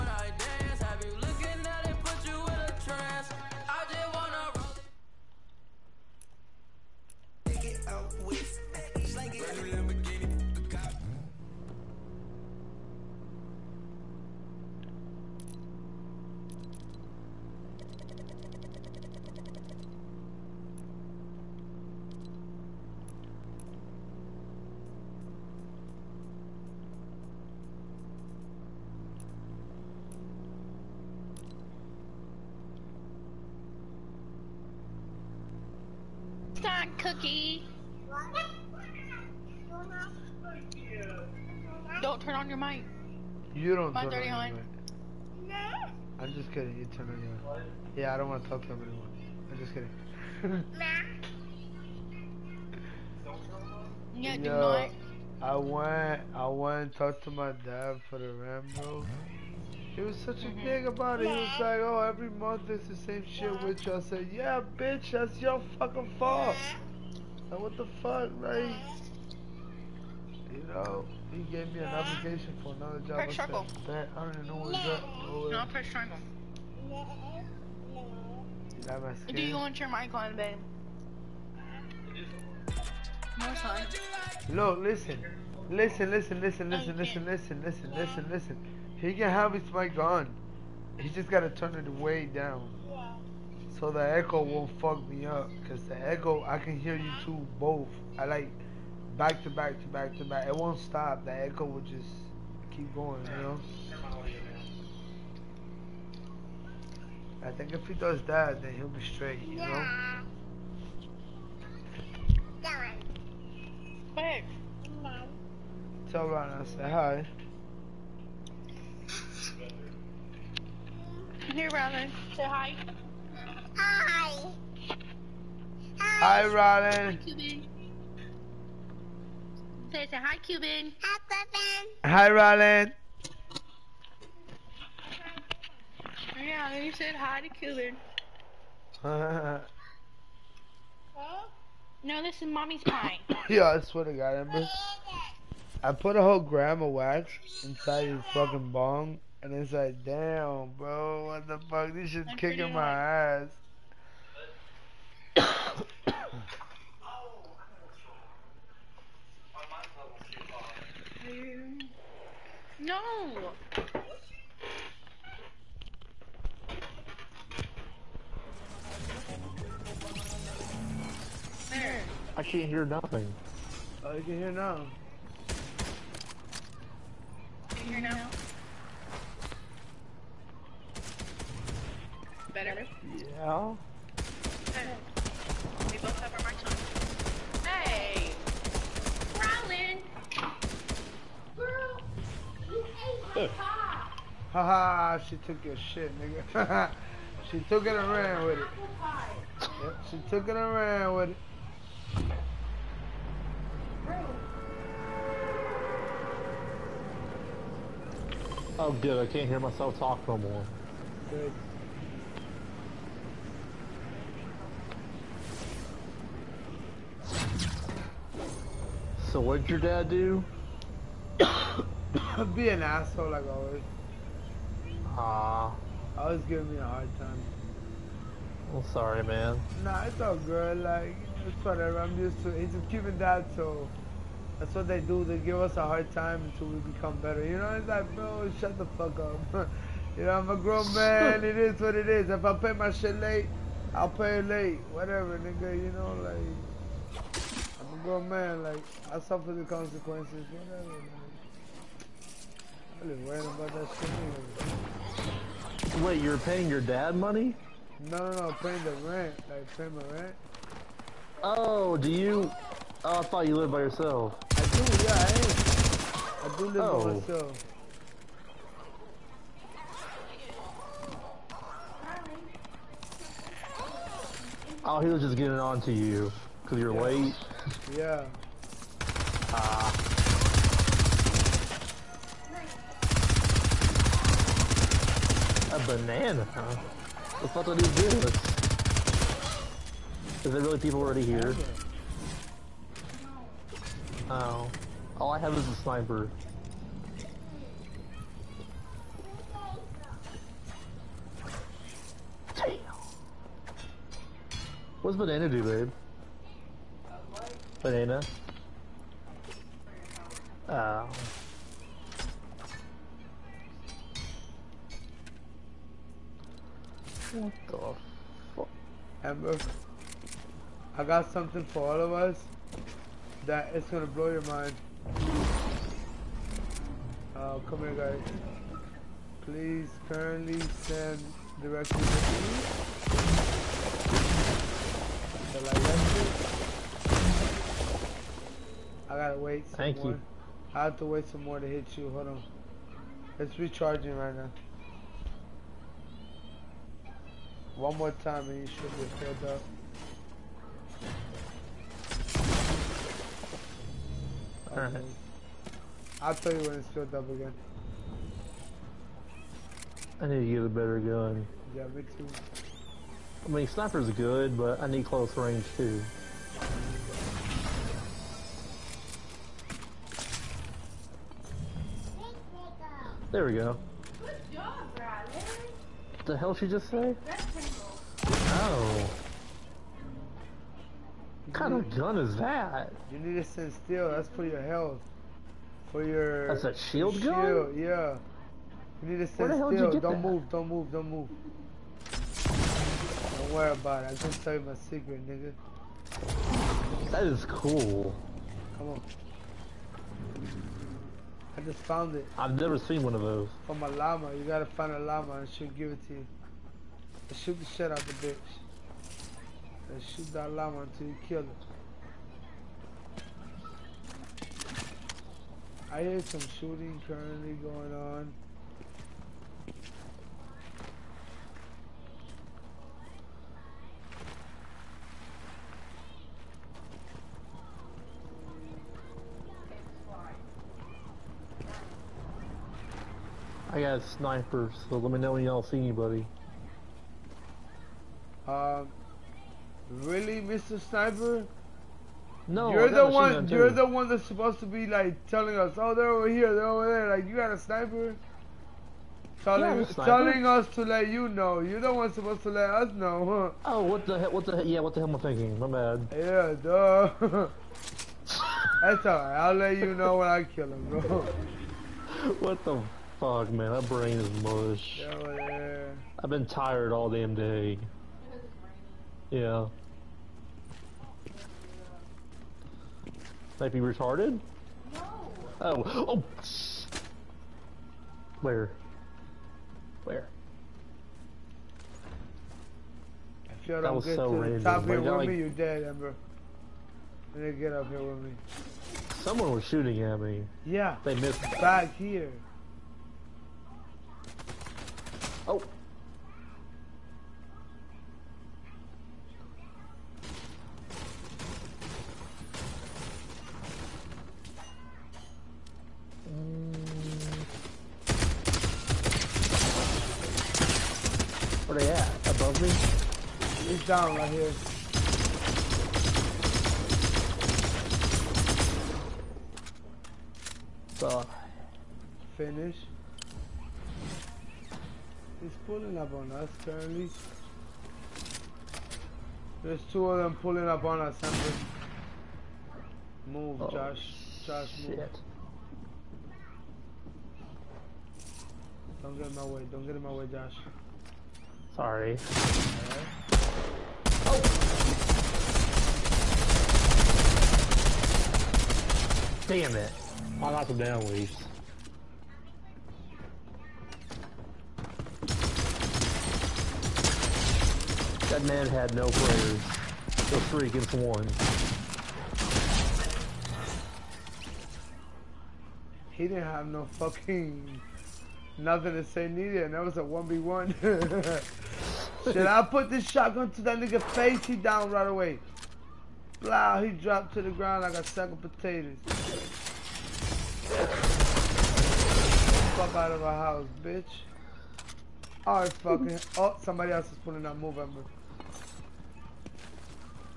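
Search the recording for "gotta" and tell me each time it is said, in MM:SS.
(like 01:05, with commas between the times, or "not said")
01:31, 05:39, 06:44.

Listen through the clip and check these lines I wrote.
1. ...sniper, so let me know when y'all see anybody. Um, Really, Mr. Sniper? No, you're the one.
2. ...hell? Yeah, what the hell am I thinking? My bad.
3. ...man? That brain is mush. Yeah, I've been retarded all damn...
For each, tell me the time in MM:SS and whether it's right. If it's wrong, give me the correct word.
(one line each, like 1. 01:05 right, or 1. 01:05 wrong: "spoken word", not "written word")
1. 07:14 right
2. 07:34 right
3. 07:43 wrong: "tired", not "retarded".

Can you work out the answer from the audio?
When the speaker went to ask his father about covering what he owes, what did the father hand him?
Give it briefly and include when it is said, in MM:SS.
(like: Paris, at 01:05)
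An application for another job, at 01:11.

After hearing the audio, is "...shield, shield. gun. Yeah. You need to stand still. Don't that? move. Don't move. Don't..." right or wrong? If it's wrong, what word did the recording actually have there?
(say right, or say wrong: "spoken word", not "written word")
right.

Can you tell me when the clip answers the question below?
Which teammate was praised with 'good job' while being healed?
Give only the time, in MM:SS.
06:14.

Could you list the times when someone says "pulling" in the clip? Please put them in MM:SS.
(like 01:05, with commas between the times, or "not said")
08:45, 08:50, 09:47.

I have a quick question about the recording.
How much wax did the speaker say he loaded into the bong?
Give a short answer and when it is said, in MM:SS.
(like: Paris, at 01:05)
A whole gram, at 02:26.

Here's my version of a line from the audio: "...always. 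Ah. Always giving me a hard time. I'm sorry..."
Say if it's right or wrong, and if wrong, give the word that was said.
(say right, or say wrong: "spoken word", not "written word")
right.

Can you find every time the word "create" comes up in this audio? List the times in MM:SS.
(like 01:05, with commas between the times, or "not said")
not said.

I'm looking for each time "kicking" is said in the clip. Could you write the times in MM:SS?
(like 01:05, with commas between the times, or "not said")
02:32.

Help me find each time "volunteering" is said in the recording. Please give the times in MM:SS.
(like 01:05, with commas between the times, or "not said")
not said.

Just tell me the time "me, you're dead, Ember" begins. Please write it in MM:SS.
08:05.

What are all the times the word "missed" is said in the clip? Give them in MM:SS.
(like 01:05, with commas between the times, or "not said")
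08:11.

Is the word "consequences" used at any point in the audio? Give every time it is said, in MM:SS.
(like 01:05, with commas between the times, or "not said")
04:09.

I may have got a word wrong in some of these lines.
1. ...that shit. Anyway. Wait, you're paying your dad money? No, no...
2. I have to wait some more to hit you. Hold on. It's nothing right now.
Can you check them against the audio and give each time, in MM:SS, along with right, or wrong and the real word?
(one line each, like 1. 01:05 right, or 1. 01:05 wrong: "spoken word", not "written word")
1. 04:13 right
2. 05:40 wrong: "recharging", not "nothing".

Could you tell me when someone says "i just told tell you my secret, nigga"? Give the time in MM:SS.
06:34.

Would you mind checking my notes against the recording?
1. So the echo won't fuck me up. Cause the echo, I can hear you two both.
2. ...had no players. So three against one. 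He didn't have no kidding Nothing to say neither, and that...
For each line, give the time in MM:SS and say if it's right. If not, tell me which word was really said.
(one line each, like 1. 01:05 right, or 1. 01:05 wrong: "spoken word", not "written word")
1. 01:33 right
2. 09:18 wrong: "fucking", not "kidding".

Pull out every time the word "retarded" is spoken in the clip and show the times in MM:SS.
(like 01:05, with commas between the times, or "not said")
07:53.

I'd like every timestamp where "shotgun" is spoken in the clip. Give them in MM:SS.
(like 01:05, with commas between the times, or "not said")
09:33.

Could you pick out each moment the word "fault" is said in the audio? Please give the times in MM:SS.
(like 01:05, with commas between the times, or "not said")
01:06.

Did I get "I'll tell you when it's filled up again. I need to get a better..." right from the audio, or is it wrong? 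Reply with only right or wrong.
right.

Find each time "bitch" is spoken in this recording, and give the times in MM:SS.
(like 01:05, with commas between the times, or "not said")
01:04, 06:48, 09:43.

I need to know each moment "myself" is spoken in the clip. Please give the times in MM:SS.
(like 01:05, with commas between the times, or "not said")
03:29, 04:27.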